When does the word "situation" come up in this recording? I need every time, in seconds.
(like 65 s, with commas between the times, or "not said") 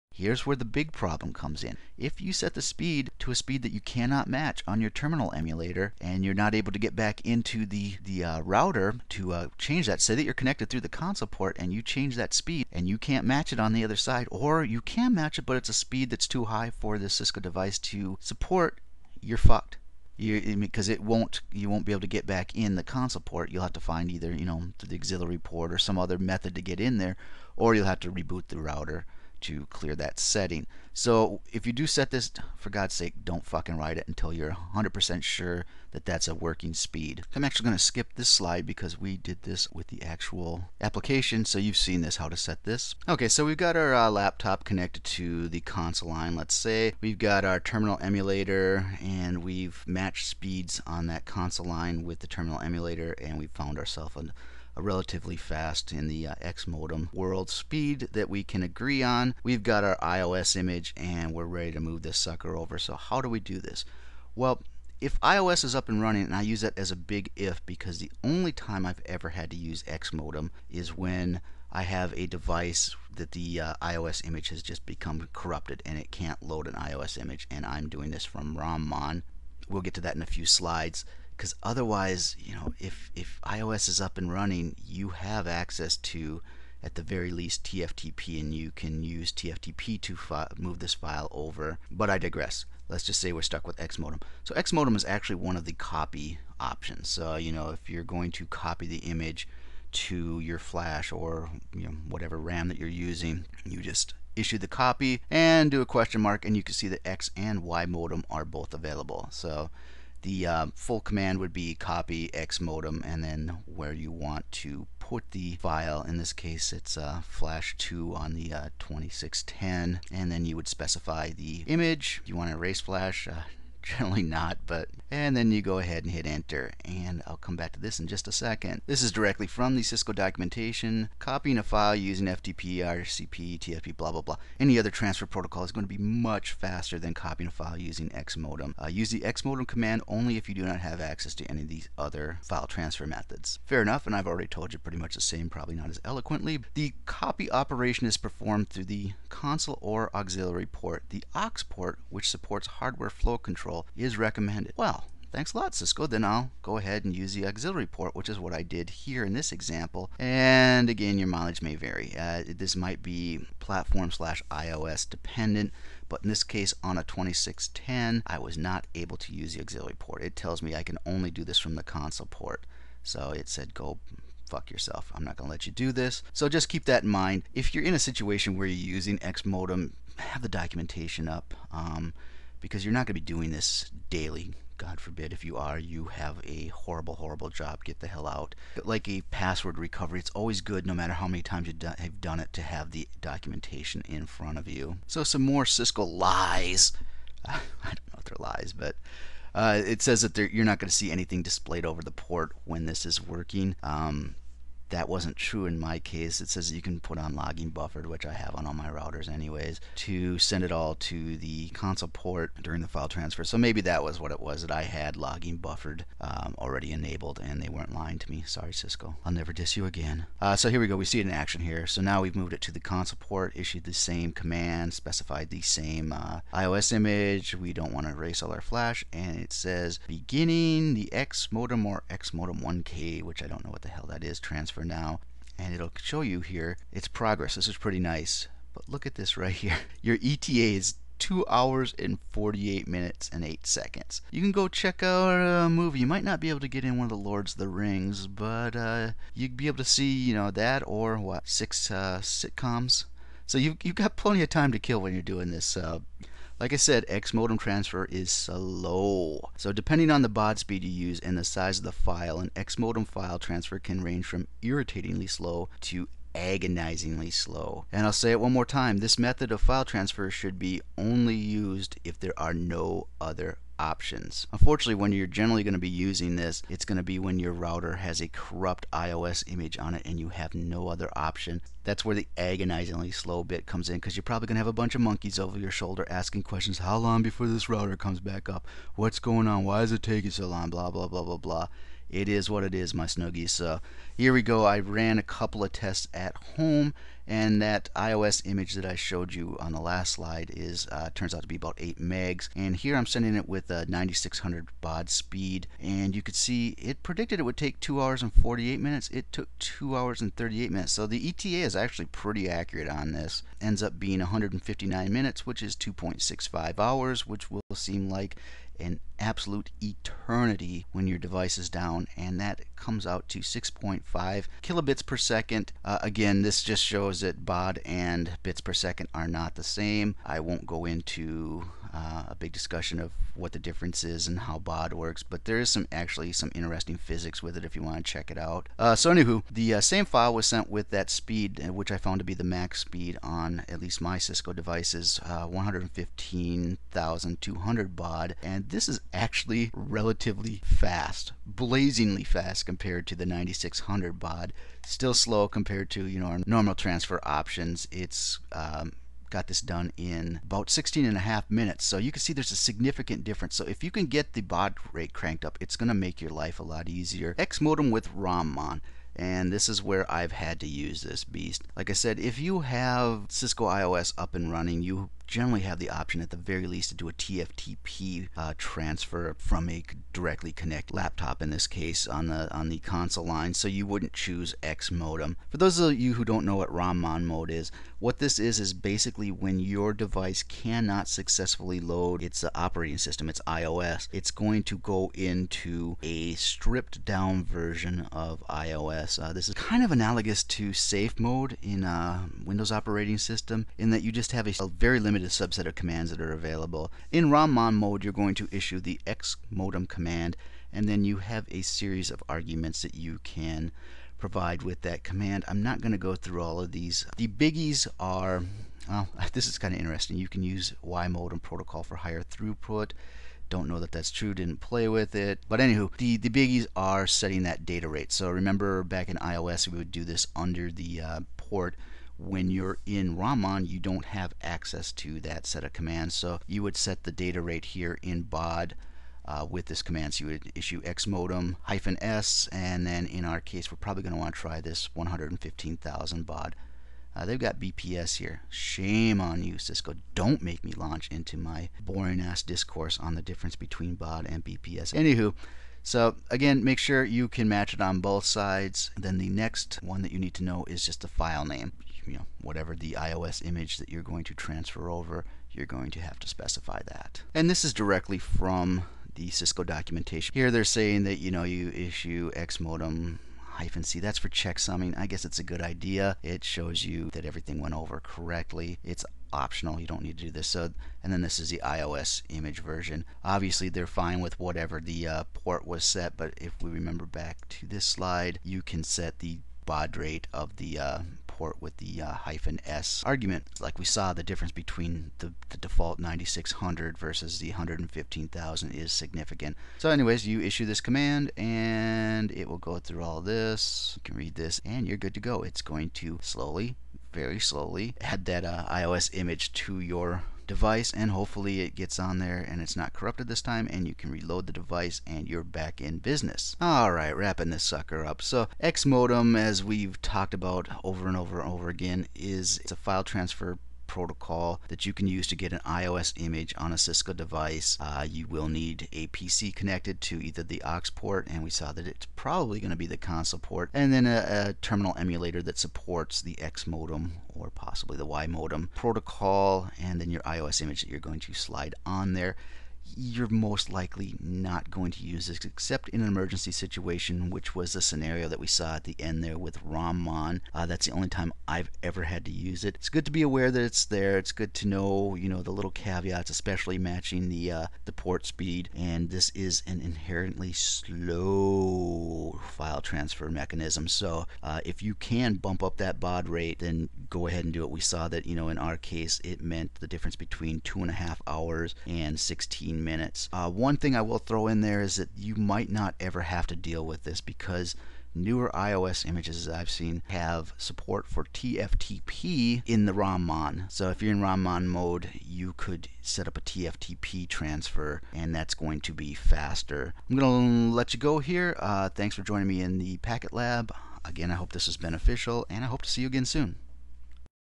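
177 s, 546 s.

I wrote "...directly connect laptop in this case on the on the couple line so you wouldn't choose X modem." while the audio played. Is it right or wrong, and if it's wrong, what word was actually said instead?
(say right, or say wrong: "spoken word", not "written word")
wrong: "console", not "couple".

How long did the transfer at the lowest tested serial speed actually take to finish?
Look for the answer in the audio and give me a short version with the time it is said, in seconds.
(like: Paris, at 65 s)
2 hours 38 minutes, at 309 s.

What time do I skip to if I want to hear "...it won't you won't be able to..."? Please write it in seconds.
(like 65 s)
20 s.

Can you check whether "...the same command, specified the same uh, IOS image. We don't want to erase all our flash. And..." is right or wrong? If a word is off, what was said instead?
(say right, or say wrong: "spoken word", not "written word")
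right.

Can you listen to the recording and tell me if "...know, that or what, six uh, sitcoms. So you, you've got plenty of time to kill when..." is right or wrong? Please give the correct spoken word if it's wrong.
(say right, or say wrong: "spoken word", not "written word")
right.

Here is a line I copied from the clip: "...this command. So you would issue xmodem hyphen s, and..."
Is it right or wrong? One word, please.
right.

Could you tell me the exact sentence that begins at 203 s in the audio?
Um, that wasn't true in my case.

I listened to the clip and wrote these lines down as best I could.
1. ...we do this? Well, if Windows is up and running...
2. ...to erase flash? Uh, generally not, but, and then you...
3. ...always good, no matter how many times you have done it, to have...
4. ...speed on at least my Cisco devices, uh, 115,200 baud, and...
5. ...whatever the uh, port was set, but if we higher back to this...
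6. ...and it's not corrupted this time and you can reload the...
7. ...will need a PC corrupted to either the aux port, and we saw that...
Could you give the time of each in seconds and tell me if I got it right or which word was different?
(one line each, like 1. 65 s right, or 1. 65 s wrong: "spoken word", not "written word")
1. 63 s wrong: "IOS", not "Windows"
2. 122 s right
3. 190 s right
4. 342 s right
5. 484 s wrong: "remember", not "higher"
6. 512 s right
7. 528 s wrong: "connected", not "corrupted".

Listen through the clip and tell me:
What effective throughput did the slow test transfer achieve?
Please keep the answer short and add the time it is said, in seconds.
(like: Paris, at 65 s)
6.5 kilobits per second, at 323 s.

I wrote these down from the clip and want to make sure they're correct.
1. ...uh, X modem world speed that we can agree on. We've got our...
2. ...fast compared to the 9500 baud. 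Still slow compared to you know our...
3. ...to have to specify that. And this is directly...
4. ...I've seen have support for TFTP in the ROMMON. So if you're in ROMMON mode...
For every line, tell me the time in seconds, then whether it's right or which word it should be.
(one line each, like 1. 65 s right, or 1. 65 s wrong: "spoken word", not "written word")
1. 56 s right
2. 352 s wrong: "9600", not "9500"
3. 465 s right
4. 579 s right.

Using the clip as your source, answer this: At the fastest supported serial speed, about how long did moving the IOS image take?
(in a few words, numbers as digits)
16 and a half minutes.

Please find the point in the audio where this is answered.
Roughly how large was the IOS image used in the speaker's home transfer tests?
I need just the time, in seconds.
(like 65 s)
301 s.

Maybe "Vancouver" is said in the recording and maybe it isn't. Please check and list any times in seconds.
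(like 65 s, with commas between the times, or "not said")
not said.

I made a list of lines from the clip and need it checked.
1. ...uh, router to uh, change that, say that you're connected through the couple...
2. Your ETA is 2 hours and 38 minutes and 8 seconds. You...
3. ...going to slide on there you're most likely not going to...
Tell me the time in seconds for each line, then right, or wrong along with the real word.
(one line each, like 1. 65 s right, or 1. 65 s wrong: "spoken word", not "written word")
1. 8 s wrong: "console", not "couple"
2. 240 s wrong: "48", not "38"
3. 541 s right.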